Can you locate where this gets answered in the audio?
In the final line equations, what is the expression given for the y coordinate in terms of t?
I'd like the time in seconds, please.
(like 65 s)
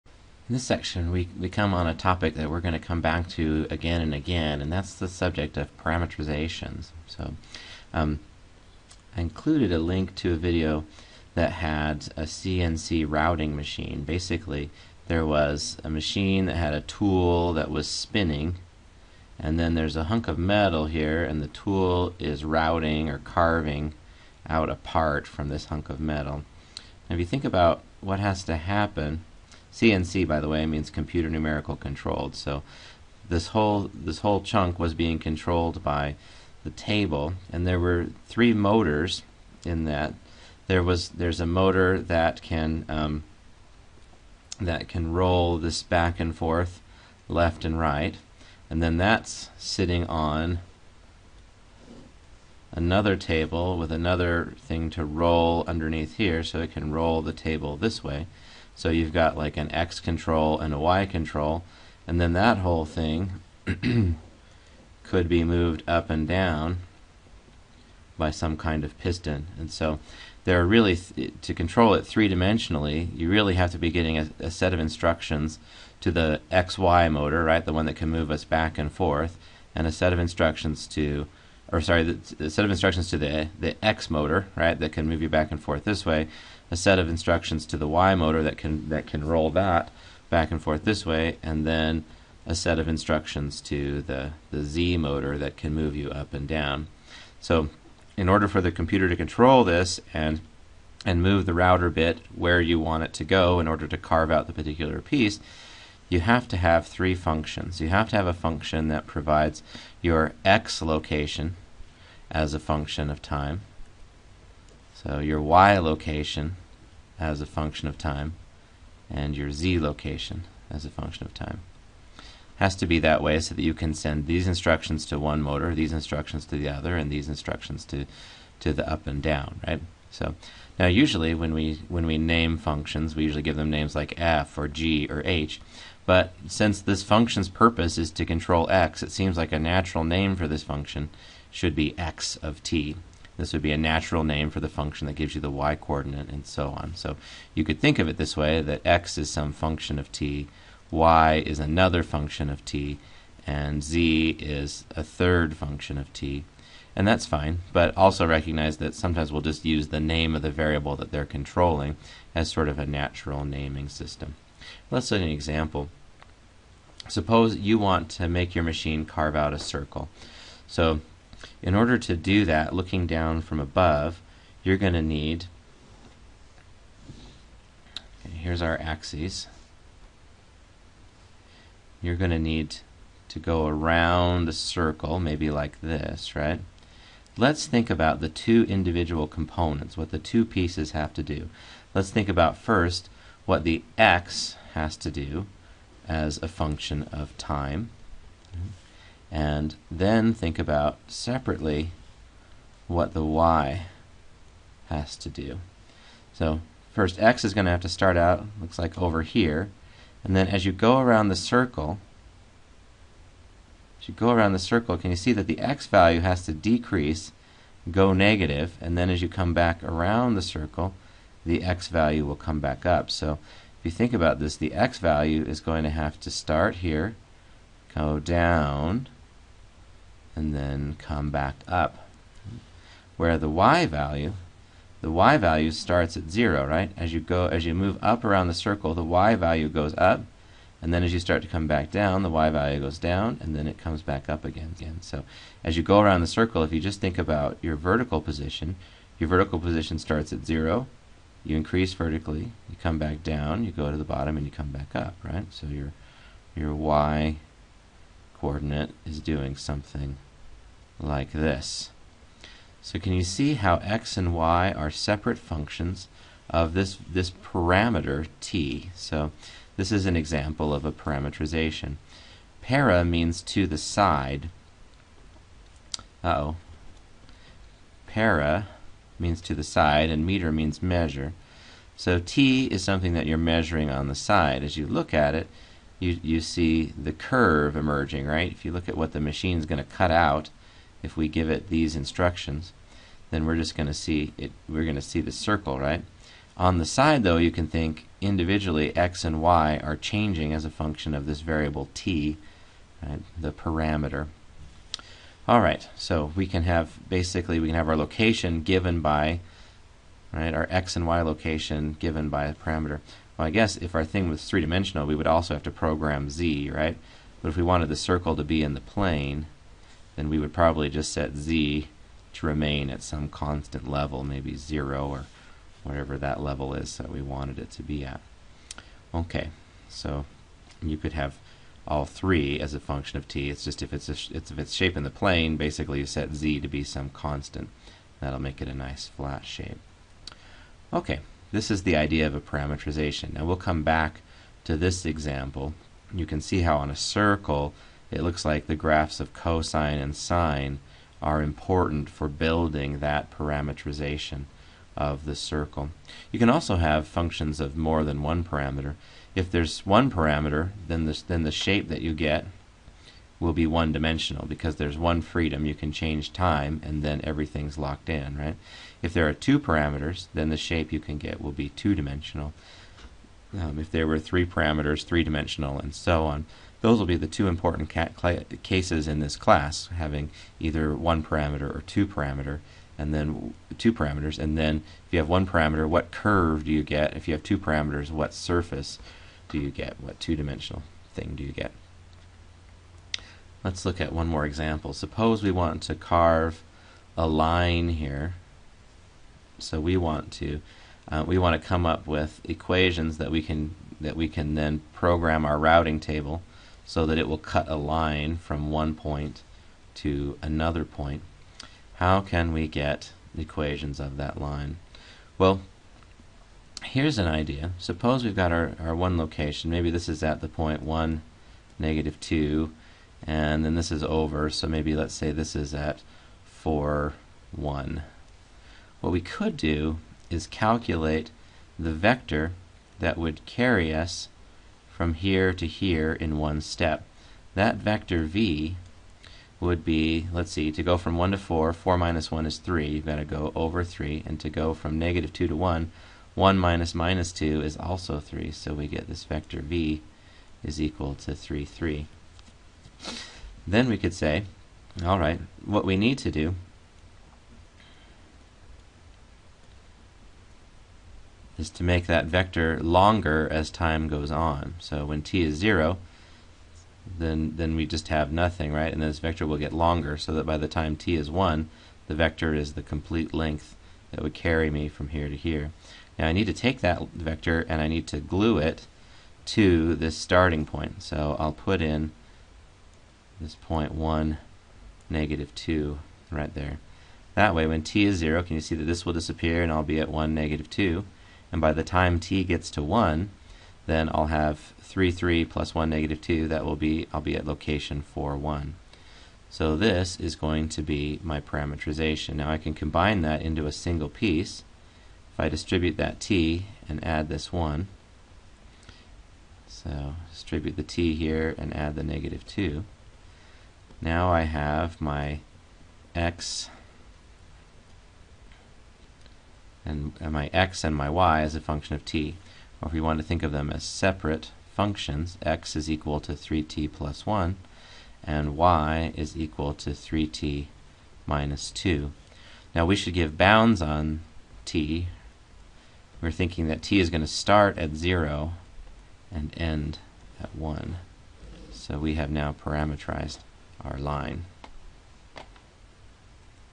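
529 s.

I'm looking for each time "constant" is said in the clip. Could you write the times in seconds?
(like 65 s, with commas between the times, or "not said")
323 s, 337 s.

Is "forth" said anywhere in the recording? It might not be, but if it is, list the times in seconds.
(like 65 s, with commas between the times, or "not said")
46 s, 78 s, 85 s, 90 s.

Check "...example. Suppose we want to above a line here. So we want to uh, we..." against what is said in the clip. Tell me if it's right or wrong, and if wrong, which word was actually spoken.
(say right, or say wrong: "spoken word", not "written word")
wrong: "carve", not "above".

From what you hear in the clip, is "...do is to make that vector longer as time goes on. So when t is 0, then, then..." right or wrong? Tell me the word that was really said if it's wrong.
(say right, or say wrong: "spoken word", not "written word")
right.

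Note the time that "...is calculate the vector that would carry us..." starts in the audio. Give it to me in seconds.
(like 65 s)
430 s.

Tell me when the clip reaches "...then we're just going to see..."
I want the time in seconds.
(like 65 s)
293 s.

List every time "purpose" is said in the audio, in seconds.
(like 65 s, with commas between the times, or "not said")
137 s.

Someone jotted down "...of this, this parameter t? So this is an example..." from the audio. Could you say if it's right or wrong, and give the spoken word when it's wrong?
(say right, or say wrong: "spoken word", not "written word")
right.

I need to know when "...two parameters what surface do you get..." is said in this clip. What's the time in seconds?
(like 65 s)
387 s.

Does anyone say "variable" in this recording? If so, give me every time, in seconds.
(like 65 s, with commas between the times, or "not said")
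160 s, 301 s.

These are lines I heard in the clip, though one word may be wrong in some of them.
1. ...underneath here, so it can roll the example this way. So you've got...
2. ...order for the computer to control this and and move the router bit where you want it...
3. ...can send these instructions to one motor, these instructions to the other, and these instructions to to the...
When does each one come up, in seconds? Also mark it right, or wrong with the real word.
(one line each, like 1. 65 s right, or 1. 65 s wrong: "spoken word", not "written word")
1. 55 s wrong: "table", not "example"
2. 98 s right
3. 123 s right.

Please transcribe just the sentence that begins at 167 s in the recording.
Suppose you want to make your machine carve out a circle.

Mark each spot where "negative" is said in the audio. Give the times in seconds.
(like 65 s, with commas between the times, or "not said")
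218 s, 421 s, 444 s, 485 s, 490 s, 495 s, 512 s.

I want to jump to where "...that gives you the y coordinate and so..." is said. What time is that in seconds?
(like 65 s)
145 s.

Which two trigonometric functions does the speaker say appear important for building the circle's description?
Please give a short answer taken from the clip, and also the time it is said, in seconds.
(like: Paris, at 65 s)
cosine and sine, at 349 s.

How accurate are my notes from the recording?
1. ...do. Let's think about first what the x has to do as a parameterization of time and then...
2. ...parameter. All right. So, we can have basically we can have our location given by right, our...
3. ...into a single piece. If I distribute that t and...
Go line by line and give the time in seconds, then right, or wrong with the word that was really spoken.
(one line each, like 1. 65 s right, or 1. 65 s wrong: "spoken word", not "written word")
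1. 191 s wrong: "function", not "parameterization"
2. 303 s right
3. 503 s right.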